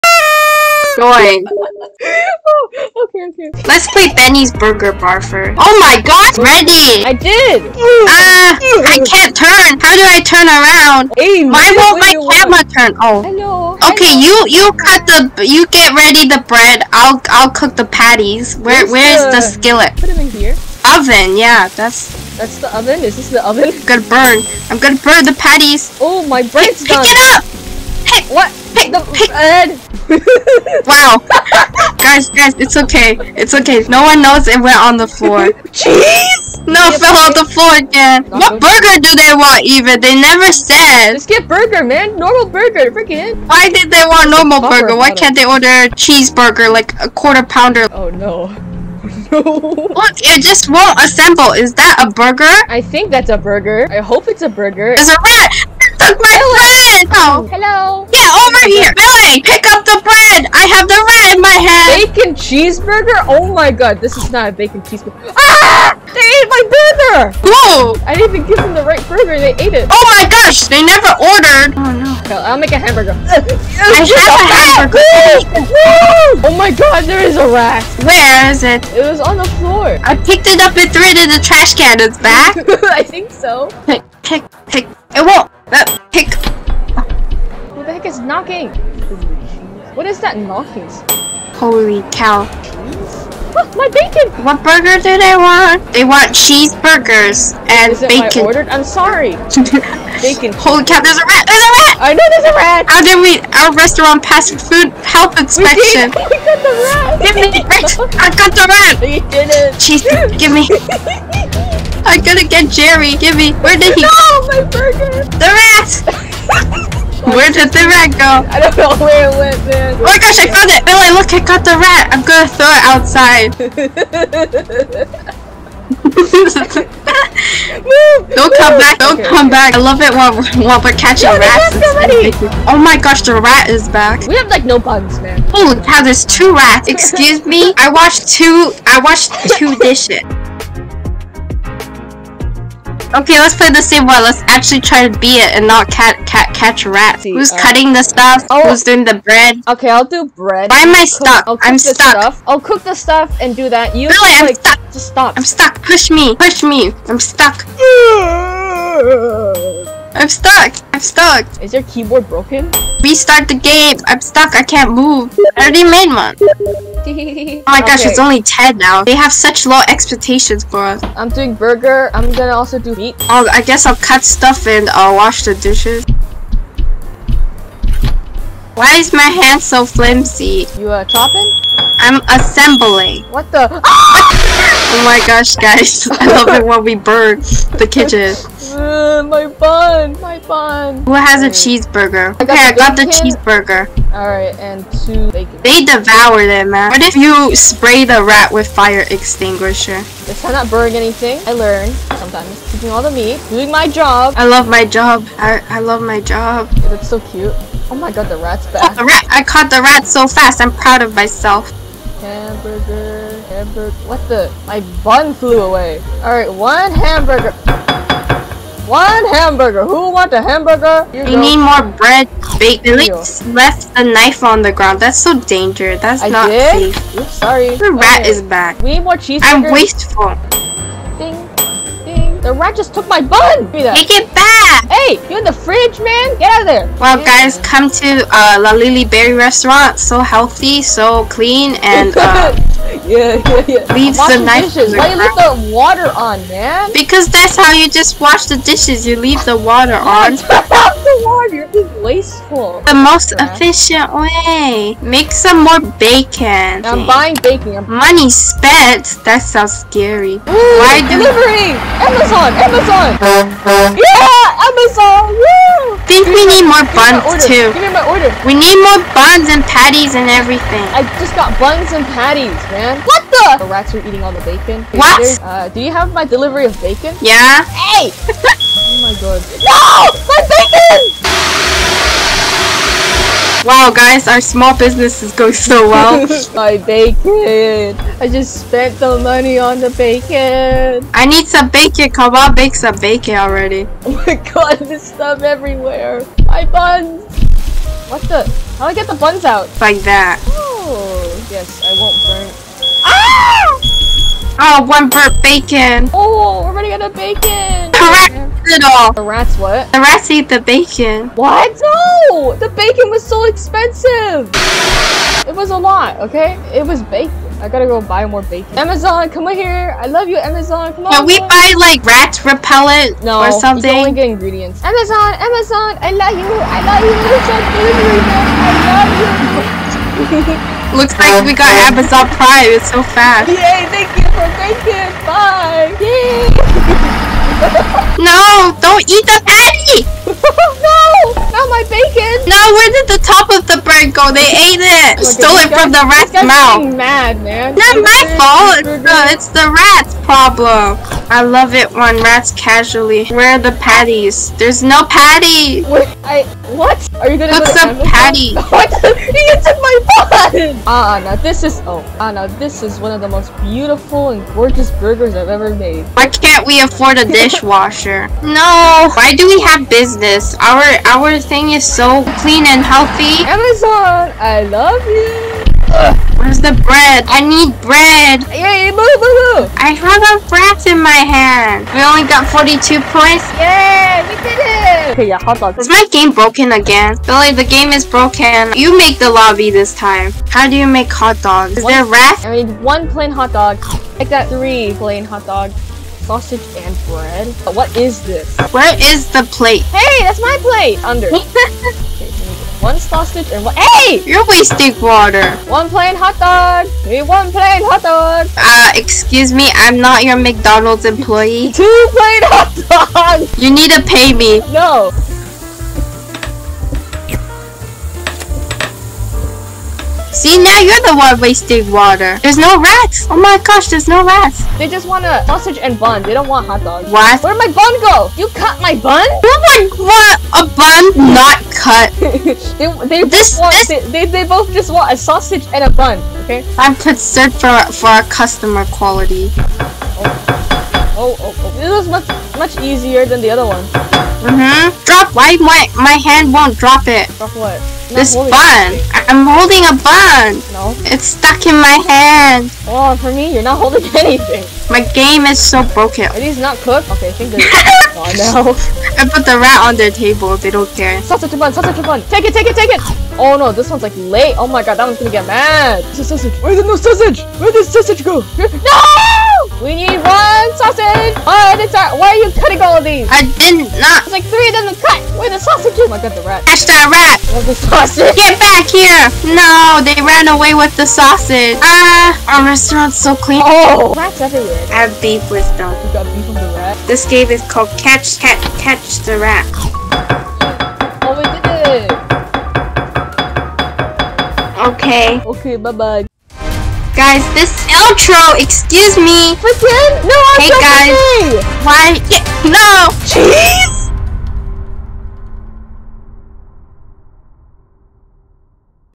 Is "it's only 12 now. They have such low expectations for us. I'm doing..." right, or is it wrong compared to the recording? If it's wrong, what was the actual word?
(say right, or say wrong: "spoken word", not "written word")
wrong: "10", not "12".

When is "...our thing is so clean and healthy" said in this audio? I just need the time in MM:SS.
06:11.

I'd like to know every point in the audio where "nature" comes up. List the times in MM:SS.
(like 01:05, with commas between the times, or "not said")
not said.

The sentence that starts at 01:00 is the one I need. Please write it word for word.
I have the bread in my hand.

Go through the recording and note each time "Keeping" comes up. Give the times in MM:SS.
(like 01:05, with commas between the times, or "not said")
03:22.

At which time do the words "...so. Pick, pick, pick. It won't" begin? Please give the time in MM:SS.
01:23.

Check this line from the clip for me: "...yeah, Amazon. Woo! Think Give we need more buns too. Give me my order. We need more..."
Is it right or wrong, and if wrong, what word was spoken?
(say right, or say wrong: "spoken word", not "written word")
right.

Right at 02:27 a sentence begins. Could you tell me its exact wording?
See, Who's uh, cutting the stuff?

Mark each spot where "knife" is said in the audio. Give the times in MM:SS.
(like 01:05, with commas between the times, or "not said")
03:44, 04:04.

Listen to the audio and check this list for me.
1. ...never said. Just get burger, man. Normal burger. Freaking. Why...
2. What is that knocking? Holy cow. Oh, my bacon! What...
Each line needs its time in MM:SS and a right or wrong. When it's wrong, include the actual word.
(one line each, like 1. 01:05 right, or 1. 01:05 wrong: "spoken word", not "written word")
1. 00:40 right
2. 01:29 right.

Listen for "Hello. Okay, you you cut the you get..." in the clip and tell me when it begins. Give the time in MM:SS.
00:13.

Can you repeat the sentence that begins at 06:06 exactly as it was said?
Why can't we afford a dishwasher?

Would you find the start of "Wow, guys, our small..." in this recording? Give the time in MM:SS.
04:43.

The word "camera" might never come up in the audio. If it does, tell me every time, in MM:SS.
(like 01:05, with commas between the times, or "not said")
00:12.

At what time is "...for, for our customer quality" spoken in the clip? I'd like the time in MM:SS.
07:17.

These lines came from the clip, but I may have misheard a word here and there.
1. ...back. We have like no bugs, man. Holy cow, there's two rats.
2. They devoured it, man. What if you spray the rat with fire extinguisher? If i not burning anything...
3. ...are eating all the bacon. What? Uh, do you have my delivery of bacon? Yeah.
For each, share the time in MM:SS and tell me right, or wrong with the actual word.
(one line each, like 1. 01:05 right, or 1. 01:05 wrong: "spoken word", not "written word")
1. 02:13 right
2. 03:15 right
3. 04:33 right.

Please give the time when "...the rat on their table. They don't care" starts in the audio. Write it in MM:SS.
07:39.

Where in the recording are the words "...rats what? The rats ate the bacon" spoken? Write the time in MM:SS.
05:09.